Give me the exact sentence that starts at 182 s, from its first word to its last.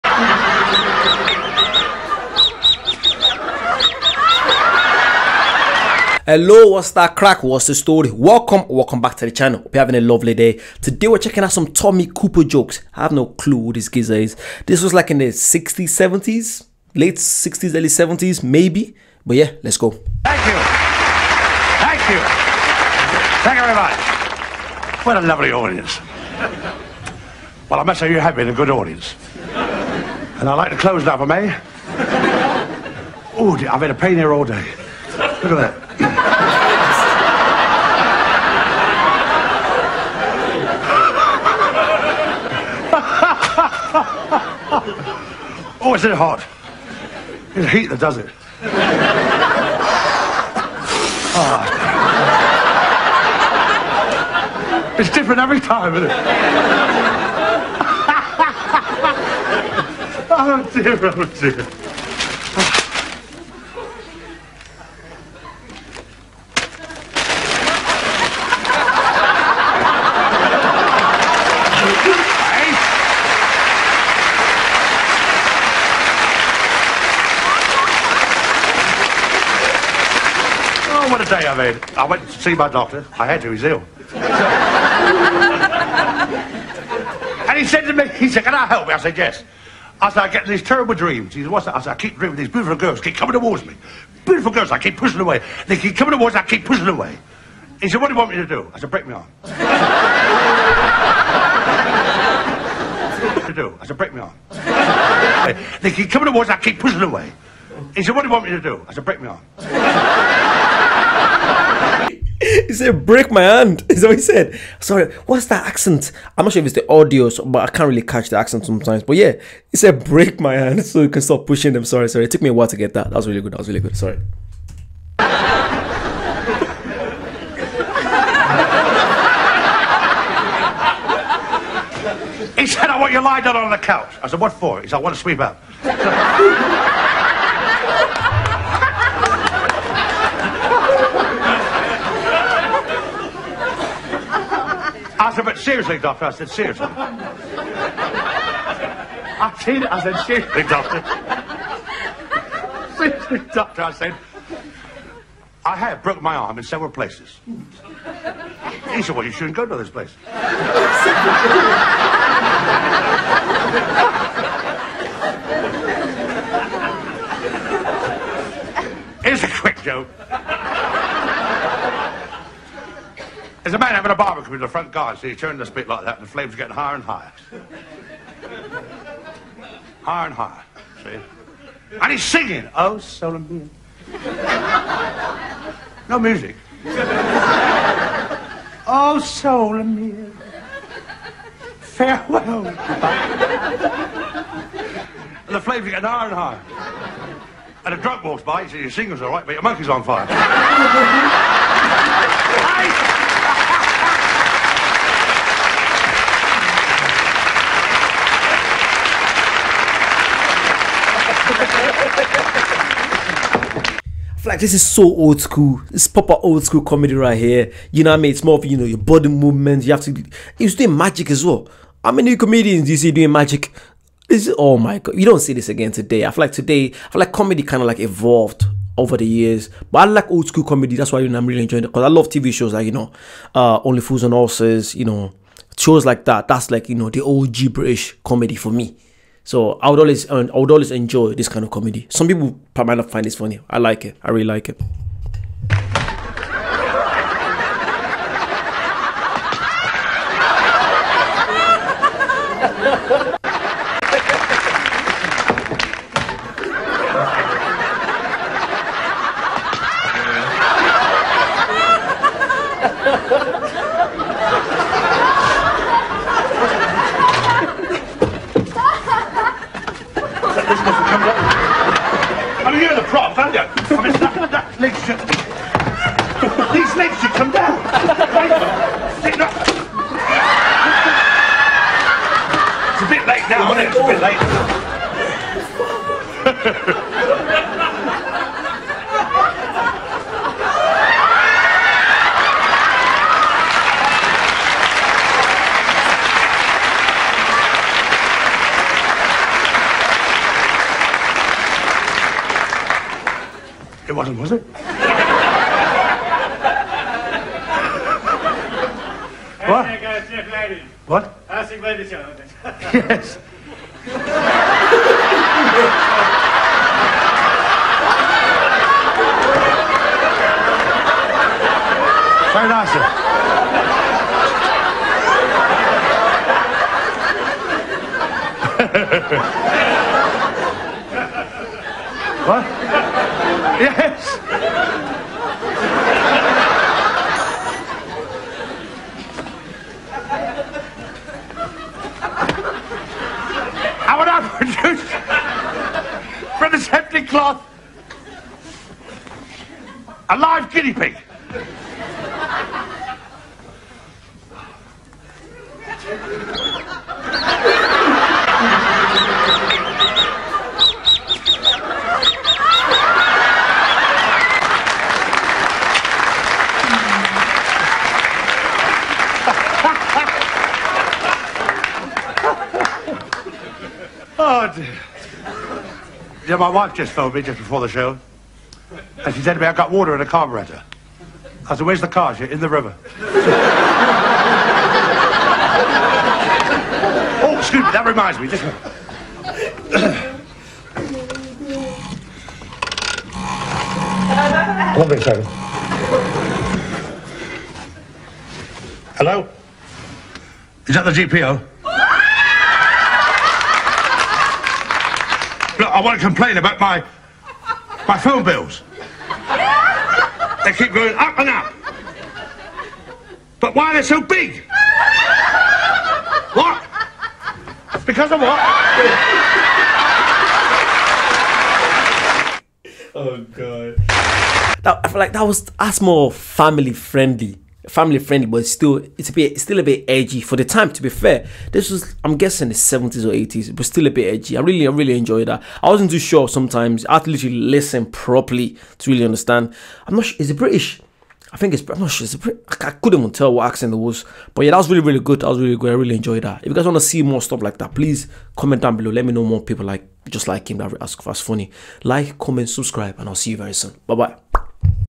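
And he's singing, Oh, soul and being.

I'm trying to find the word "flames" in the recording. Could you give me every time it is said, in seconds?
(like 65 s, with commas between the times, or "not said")
176 s, 195 s.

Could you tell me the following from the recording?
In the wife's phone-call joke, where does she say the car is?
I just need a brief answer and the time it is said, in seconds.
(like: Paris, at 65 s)
in the river, at 382 s.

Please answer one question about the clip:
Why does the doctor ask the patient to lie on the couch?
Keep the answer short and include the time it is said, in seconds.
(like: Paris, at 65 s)
to sweep up, at 135 s.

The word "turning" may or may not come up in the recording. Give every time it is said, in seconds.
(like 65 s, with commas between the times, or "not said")
175 s.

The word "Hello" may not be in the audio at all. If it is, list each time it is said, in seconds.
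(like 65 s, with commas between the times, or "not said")
6 s, 399 s.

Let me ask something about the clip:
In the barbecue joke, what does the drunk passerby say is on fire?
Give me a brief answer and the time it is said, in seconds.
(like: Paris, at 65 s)
your monkey, at 199 s.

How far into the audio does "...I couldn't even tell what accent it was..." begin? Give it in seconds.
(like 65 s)
442 s.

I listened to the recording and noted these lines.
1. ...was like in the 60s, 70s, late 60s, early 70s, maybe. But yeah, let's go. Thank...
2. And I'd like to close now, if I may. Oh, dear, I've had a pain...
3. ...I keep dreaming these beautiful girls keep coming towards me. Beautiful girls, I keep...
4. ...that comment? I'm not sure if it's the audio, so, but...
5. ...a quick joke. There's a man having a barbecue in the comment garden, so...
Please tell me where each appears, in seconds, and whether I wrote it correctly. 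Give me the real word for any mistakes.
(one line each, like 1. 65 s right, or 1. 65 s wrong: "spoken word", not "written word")
1. 14 s right
2. 29 s right
3. 91 s right
4. 115 s wrong: "accent", not "comment"
5. 169 s wrong: "front", not "comment".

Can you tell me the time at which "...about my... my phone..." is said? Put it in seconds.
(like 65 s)
406 s.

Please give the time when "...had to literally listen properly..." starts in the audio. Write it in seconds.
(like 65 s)
437 s.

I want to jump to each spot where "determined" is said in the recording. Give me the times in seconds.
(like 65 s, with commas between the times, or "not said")
not said.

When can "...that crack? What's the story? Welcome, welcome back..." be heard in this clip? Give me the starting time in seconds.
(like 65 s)
6 s.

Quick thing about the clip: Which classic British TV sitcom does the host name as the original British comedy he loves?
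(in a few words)
Only Fools and Horses.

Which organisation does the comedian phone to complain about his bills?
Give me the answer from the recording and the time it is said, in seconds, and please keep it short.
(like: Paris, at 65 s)
GPO, at 401 s.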